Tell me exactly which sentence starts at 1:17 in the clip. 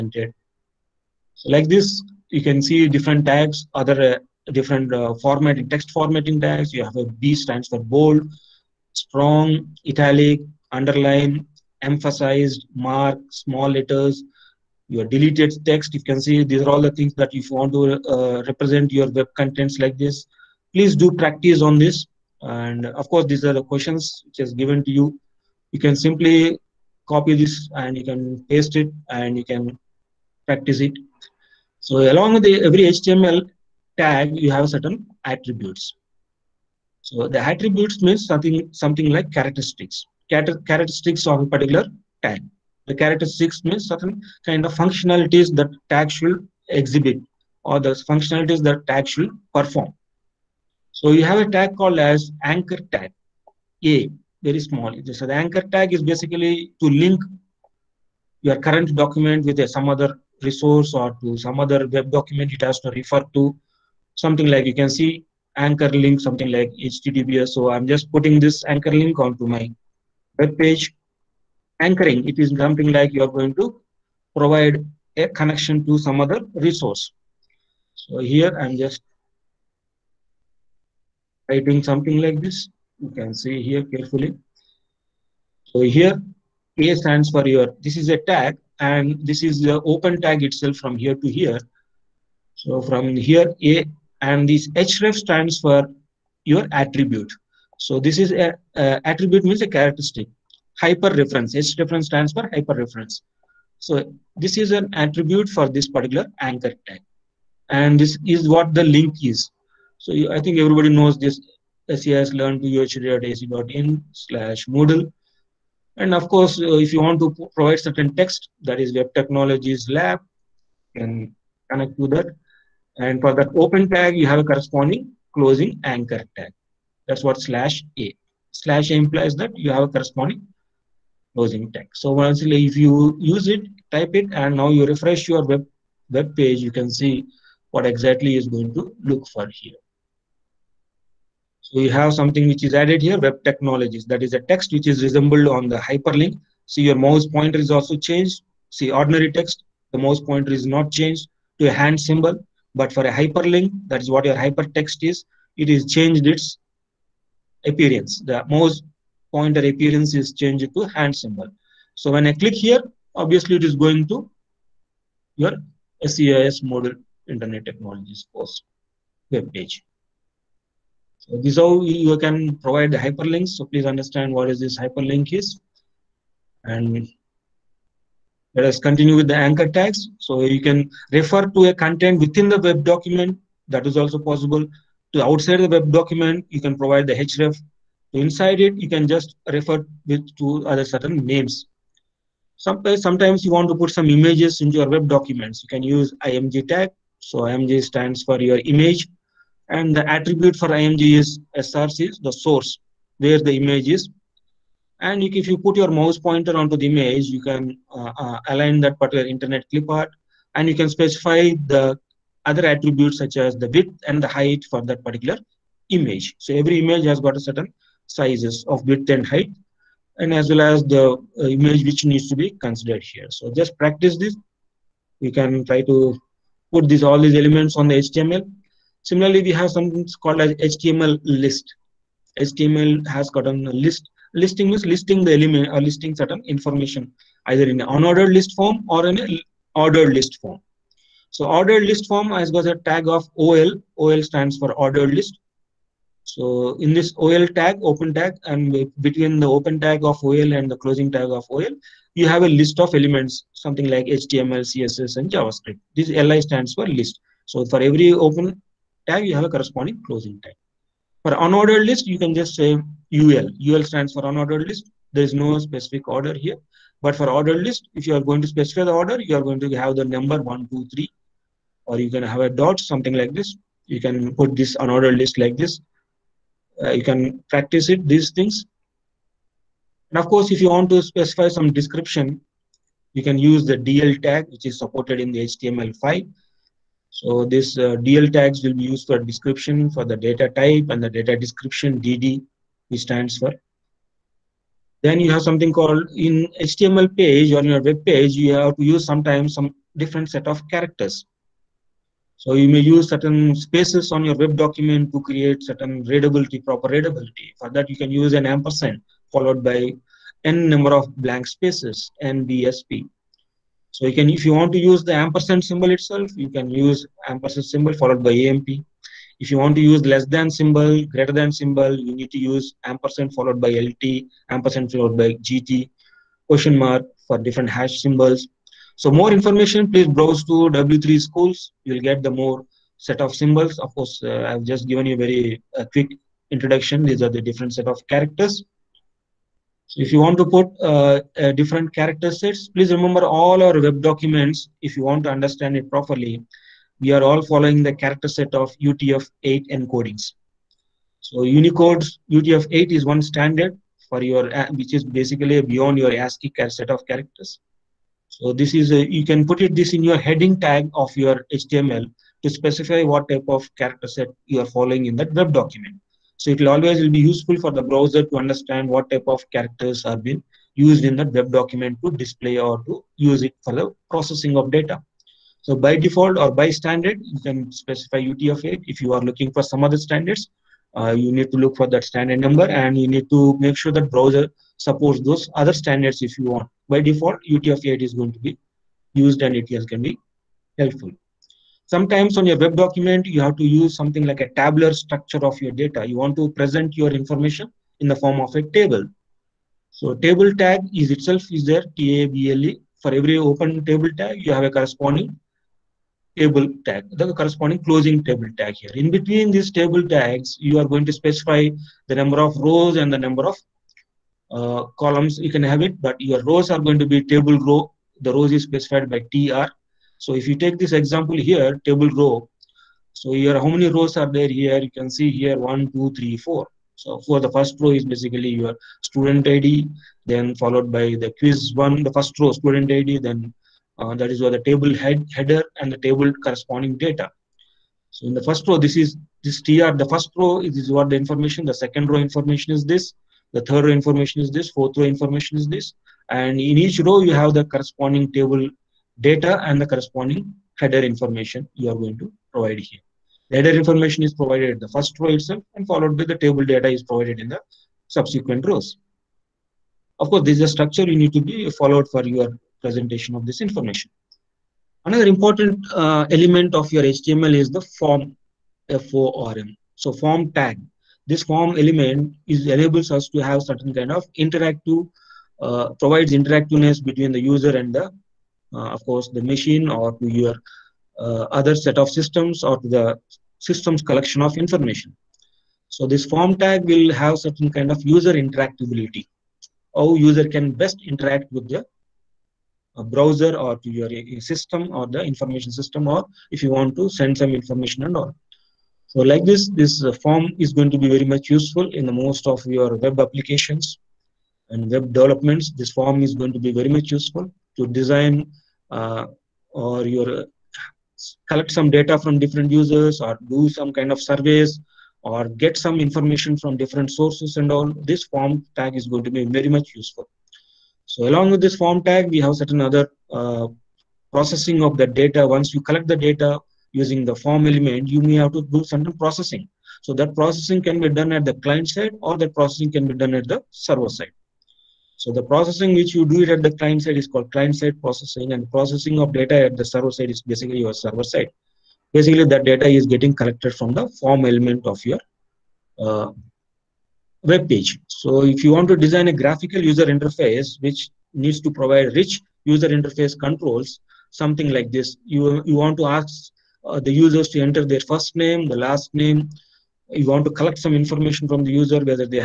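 So here I'm just writing something like this.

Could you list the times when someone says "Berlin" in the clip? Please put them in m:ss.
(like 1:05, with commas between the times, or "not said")
not said.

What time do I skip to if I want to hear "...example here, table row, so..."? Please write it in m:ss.
7:00.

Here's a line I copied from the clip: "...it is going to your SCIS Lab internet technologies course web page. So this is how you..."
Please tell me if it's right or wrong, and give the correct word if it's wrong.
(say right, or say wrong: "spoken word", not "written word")
wrong: "Moodle", not "Lab".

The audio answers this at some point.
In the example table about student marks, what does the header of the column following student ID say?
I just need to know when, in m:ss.
7:11.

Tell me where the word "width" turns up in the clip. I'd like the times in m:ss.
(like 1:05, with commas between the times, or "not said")
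3:33, 3:38.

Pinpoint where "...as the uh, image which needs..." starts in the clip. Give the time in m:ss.
3:40.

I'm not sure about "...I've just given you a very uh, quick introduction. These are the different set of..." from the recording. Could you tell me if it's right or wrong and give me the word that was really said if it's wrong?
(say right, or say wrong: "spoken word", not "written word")
right.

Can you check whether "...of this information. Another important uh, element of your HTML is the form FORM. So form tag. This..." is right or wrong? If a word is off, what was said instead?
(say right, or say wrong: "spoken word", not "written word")
right.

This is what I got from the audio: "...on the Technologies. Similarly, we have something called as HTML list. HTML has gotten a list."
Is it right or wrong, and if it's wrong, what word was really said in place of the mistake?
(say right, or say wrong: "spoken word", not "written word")
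wrong: "HTML", not "Technologies".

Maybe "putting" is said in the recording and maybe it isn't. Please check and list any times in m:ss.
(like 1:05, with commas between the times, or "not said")
1:08.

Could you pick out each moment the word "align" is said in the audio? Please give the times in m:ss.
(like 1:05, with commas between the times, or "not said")
3:28.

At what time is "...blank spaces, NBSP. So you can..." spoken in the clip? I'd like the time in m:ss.
5:11.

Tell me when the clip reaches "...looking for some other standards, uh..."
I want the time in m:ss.
6:19.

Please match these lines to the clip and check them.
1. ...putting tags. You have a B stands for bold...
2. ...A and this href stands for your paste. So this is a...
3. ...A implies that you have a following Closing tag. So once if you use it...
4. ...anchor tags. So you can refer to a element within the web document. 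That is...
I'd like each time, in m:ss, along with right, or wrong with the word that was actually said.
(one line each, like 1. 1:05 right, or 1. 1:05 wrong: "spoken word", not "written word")
1. 0:05 wrong: "formatting", not "putting"
2. 1:33 wrong: "attribute", not "paste"
3. 2:08 wrong: "corresponding", not "following"
4. 2:59 wrong: "content", not "element".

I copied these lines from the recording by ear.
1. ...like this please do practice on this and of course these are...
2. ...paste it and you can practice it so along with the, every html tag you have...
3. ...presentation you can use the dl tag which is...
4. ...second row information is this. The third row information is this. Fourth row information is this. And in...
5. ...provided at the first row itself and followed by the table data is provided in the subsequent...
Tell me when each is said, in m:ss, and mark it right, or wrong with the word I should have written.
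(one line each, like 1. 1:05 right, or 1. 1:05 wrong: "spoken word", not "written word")
1. 0:19 right
2. 0:28 right
3. 4:41 wrong: "description", not "presentation"
4. 7:21 right
5. 7:34 right.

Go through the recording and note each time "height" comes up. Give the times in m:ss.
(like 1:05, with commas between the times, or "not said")
3:34, 3:39.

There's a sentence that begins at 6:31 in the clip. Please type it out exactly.
Sometimes on your web document, you have to use something like a tabular structure of your data.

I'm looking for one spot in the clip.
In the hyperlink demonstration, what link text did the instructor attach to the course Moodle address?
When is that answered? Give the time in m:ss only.
1:58.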